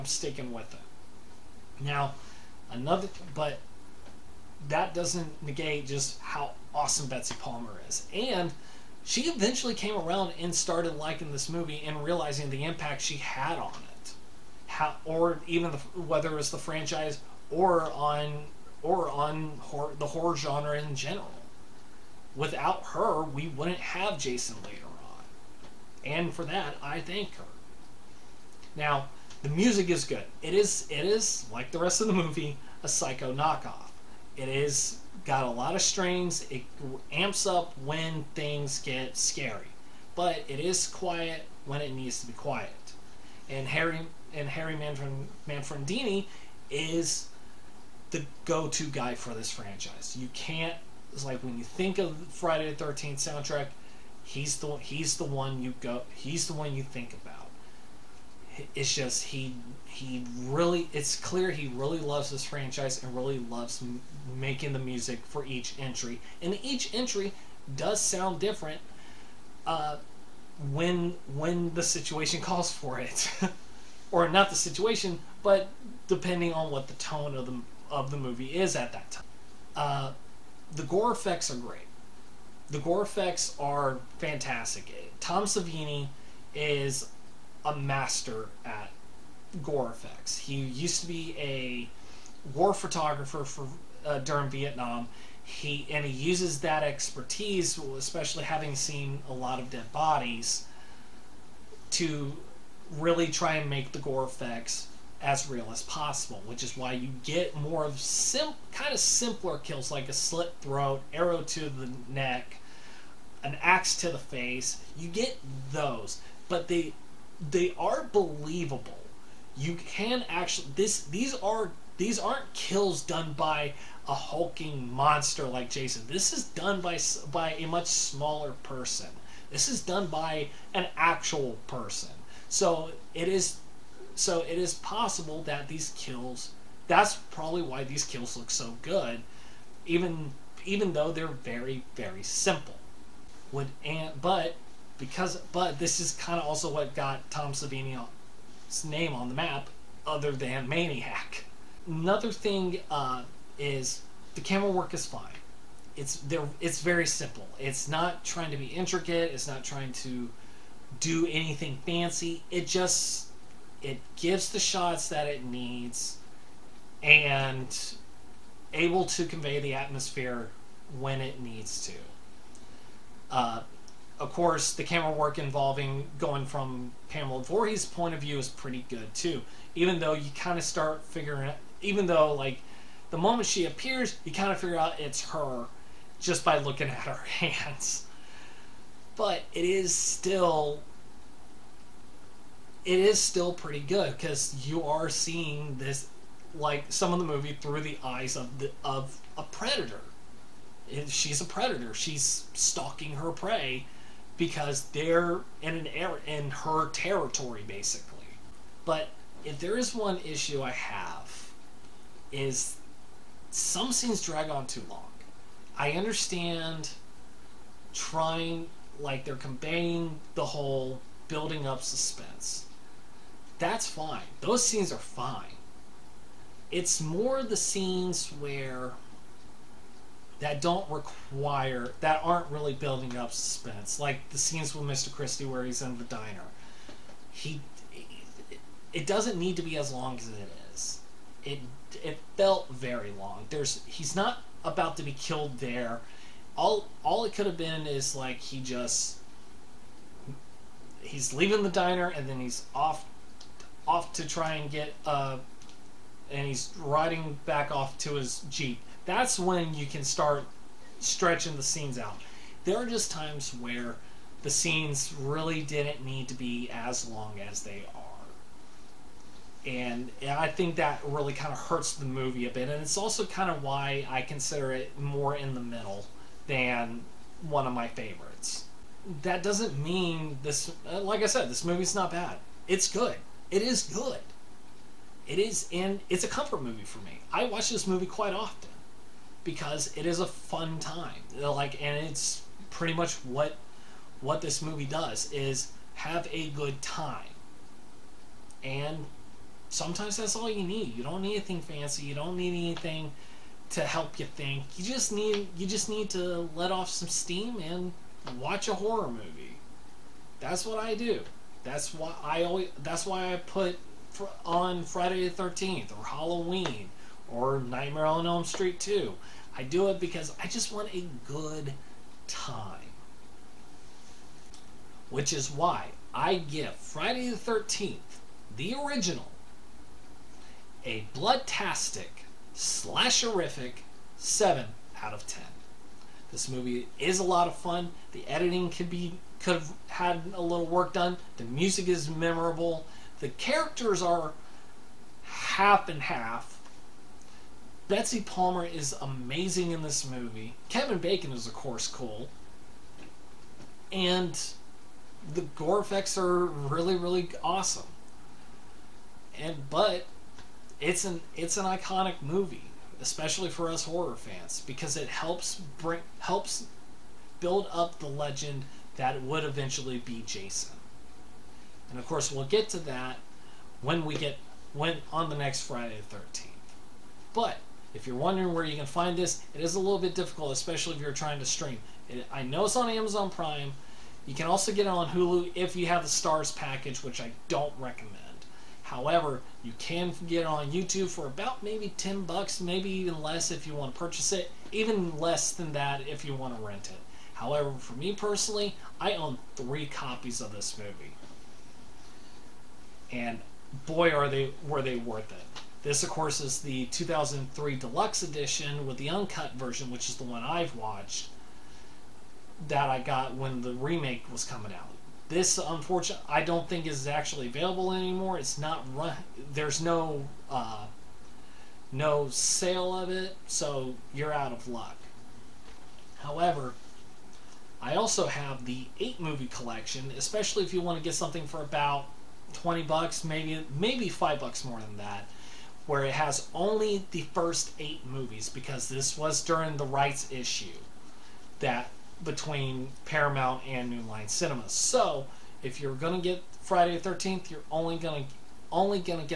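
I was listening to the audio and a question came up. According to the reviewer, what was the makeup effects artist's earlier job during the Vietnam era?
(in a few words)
war photographer.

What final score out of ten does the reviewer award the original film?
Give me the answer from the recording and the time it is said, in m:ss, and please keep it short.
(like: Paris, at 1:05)
7, at 5:34.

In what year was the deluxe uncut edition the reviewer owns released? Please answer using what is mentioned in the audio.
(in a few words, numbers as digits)
2003.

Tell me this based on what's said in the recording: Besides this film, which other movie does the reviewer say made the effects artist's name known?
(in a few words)
Maniac.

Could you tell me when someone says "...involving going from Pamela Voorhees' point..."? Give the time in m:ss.
2:55.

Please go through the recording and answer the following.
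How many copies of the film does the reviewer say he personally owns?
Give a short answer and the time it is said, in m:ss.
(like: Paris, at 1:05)
3, at 6:39.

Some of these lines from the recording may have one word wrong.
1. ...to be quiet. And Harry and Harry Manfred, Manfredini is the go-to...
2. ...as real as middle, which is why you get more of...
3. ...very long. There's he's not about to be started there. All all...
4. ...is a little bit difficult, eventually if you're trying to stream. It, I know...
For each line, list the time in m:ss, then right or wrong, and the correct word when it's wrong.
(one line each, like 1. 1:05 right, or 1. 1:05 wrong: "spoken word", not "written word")
1. 0:42 right
2. 1:45 wrong: "possible", not "middle"
3. 4:02 wrong: "killed", not "started"
4. 6:19 wrong: "especially", not "eventually".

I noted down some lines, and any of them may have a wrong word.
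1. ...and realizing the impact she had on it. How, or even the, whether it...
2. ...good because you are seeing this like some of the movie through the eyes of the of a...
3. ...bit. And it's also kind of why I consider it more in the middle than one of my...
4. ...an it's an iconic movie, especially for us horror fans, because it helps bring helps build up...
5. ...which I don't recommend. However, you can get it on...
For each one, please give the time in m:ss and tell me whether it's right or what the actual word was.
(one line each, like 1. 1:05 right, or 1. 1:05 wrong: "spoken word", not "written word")
1. 0:11 right
2. 3:13 right
3. 4:32 right
4. 6:01 right
5. 6:27 right.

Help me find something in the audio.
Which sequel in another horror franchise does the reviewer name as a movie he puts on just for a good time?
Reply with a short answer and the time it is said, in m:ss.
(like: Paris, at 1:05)
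Nightmare on Elm Street 2, at 5:17.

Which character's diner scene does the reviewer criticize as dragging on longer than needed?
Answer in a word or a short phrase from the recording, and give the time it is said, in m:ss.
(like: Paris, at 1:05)
Mr. Christie, at 3:54.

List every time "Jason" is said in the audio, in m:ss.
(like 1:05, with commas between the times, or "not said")
0:24, 2:05, 6:10.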